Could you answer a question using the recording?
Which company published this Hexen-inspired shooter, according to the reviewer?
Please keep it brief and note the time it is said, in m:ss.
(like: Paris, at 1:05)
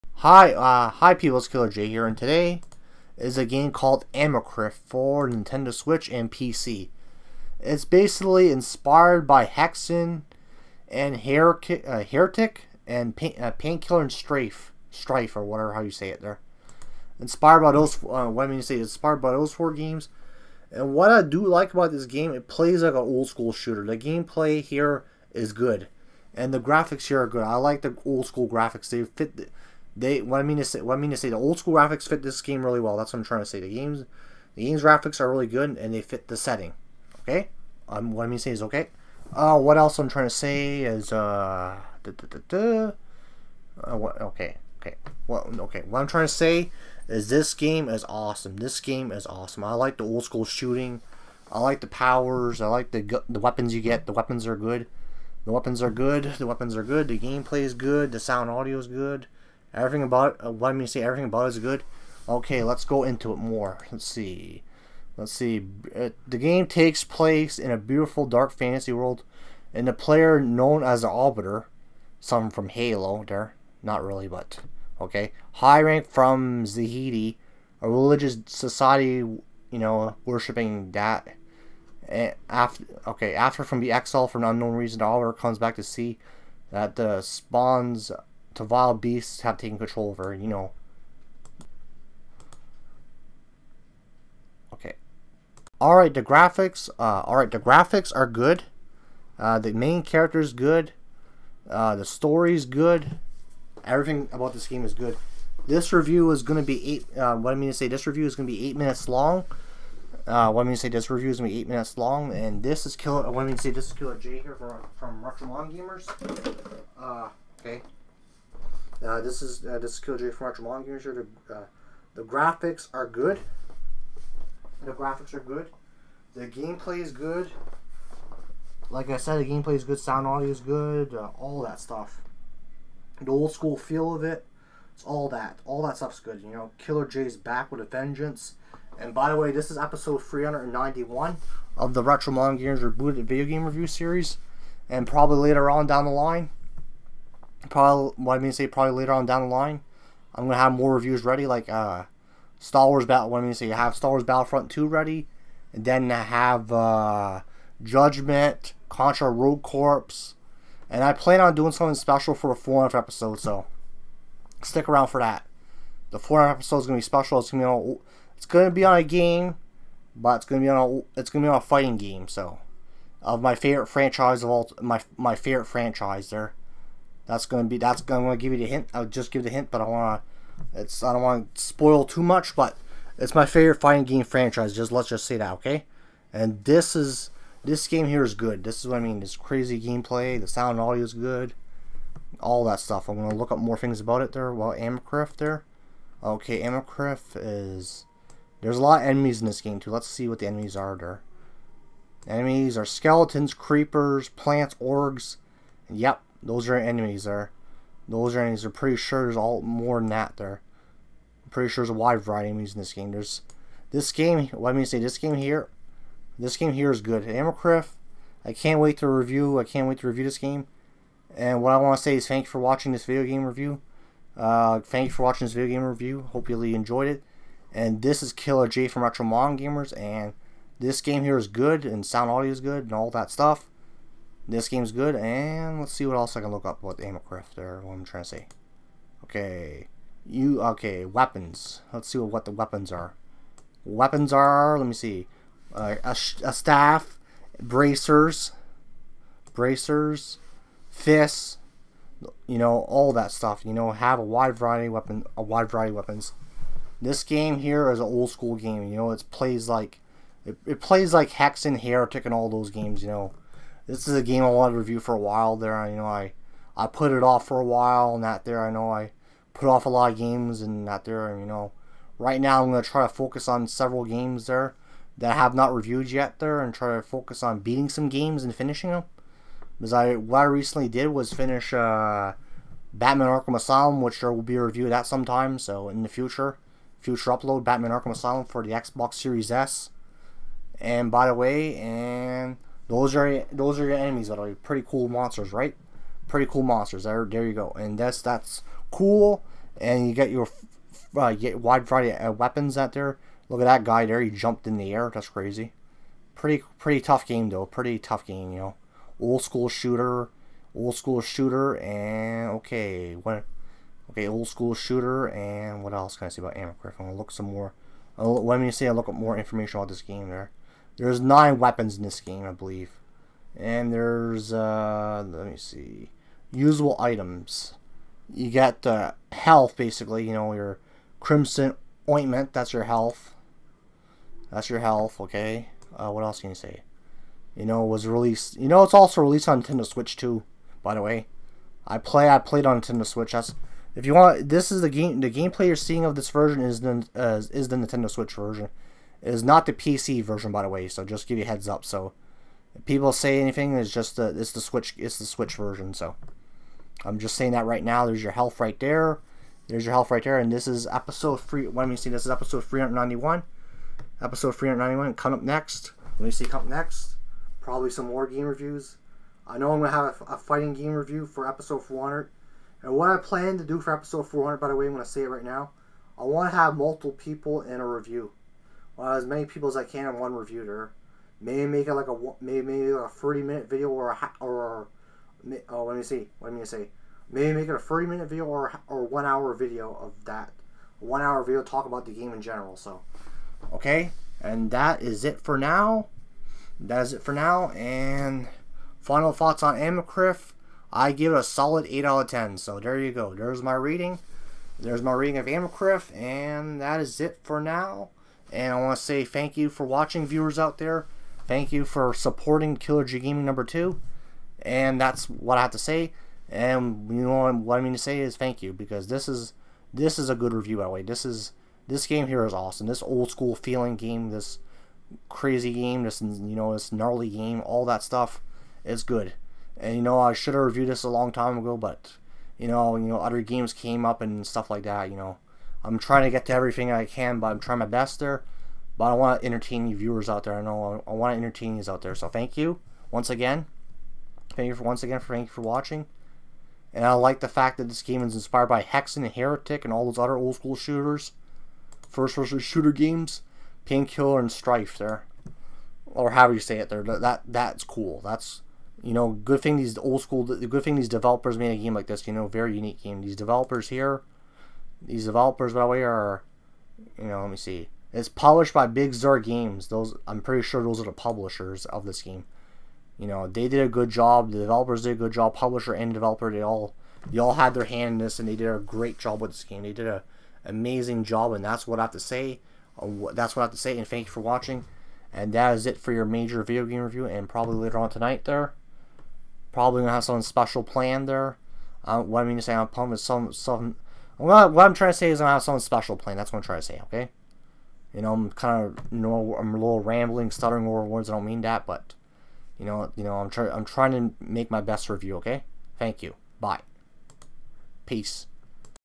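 Bigzur Games, at 7:48.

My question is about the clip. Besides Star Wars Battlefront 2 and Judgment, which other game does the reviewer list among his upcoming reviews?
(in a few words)
Contra Rogue Corps.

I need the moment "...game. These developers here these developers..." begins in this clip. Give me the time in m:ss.
7:43.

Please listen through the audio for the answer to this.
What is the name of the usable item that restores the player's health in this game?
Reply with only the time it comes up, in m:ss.
5:31.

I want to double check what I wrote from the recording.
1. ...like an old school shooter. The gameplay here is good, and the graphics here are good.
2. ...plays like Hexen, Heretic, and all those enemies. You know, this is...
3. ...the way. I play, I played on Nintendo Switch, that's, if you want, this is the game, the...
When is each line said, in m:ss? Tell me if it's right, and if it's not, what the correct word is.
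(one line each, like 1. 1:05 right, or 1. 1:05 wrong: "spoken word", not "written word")
1. 0:22 right
2. 4:20 wrong: "games", not "enemies"
3. 5:40 right.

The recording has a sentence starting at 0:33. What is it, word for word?
The games the game's graphics are really good and they fit the setting.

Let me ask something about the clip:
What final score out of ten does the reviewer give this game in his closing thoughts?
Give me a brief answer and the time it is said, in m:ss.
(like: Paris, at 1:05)
8 out of 10, at 6:41.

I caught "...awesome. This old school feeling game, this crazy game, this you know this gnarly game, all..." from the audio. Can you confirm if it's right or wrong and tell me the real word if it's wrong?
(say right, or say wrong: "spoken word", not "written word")
right.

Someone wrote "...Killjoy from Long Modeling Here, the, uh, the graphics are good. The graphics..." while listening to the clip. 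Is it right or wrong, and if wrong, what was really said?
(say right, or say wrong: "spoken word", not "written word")
wrong: "Retro", not "Long".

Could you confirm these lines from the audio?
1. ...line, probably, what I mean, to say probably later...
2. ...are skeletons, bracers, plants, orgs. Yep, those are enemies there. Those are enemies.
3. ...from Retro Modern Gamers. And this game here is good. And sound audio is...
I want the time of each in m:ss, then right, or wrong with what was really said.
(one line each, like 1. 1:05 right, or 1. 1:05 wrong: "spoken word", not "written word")
1. 2:26 right
2. 3:22 wrong: "creepers", not "bracers"
3. 3:48 right.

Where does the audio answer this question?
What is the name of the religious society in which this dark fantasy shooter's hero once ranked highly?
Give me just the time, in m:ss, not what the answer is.
1:16.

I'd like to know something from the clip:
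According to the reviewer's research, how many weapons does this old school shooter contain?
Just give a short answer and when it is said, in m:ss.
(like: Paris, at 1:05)
9, at 5:21.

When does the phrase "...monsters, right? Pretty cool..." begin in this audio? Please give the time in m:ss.
4:55.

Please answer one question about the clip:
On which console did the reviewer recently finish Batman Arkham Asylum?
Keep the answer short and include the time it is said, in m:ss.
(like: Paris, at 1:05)
Xbox Series S, at 4:48.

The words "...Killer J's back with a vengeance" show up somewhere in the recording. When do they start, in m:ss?
2:16.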